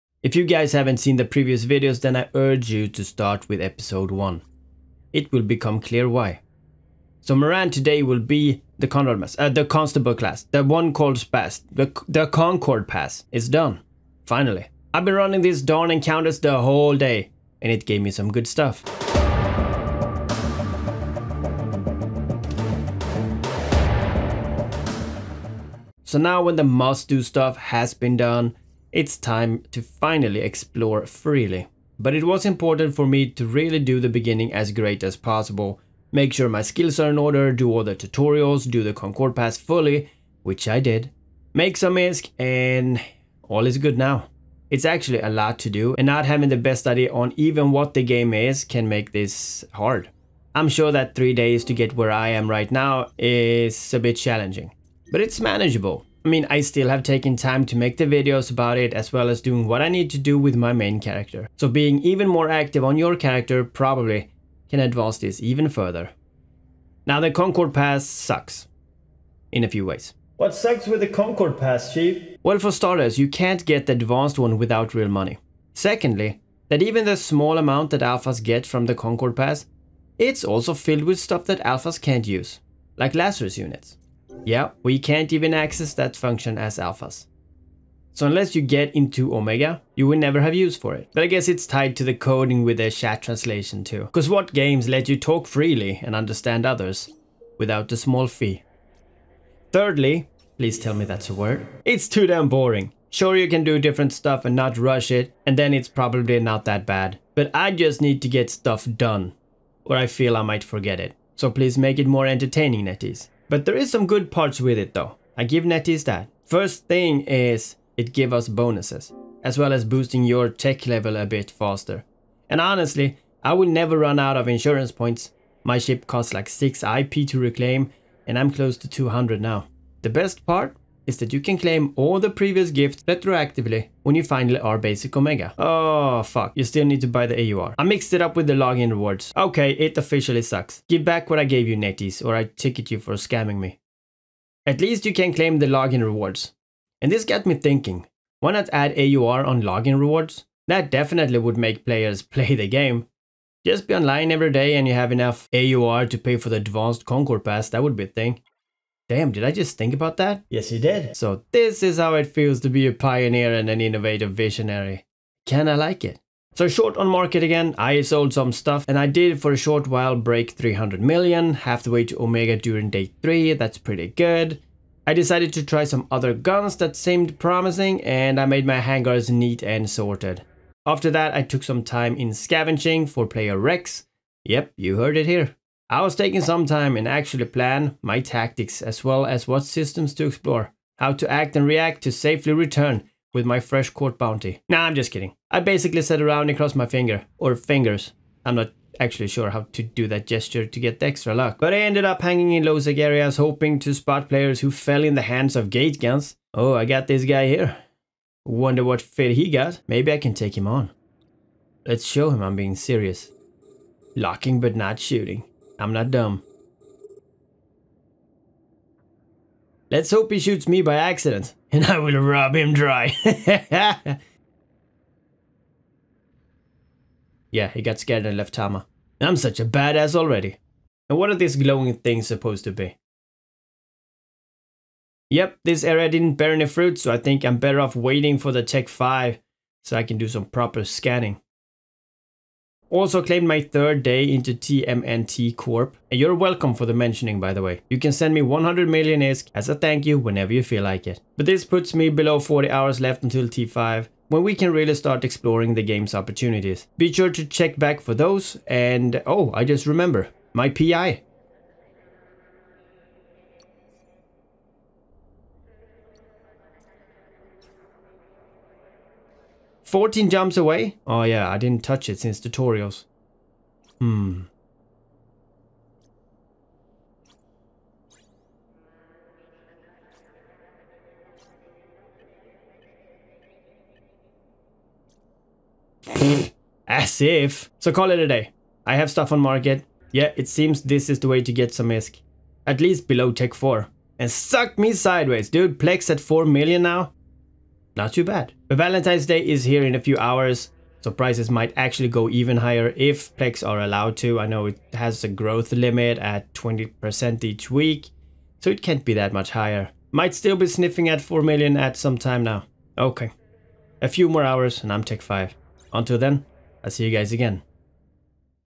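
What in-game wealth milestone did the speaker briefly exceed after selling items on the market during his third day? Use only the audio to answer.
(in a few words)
300 million.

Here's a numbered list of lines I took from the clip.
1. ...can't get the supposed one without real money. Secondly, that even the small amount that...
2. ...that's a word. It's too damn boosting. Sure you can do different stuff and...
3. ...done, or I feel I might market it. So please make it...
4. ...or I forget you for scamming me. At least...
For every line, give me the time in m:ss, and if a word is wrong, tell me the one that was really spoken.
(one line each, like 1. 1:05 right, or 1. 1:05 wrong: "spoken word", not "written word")
1. 1:13 wrong: "advanced", not "supposed"
2. 1:41 wrong: "boring", not "boosting"
3. 1:48 wrong: "forget", not "market"
4. 2:22 wrong: "ticket", not "forget".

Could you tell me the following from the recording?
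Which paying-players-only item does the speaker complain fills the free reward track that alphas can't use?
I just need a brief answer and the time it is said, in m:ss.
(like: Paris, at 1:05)
Lazarus units, at 1:23.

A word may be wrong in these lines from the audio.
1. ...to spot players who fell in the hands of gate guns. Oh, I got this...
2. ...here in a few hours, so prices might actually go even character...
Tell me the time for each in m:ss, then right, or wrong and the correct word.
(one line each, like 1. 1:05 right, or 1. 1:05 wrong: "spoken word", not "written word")
1. 3:23 right
2. 4:59 wrong: "higher", not "character".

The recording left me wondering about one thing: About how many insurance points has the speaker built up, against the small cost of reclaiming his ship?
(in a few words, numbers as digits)
200.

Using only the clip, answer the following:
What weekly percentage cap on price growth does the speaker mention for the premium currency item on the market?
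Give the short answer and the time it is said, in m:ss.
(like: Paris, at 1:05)
20%, at 5:06.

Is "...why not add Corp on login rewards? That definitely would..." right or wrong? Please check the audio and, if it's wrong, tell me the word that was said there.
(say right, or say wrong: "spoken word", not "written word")
wrong: "AUR", not "Corp".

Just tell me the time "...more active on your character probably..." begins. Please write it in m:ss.
1:02.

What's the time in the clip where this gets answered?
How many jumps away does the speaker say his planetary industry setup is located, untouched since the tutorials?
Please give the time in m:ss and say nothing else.
4:29.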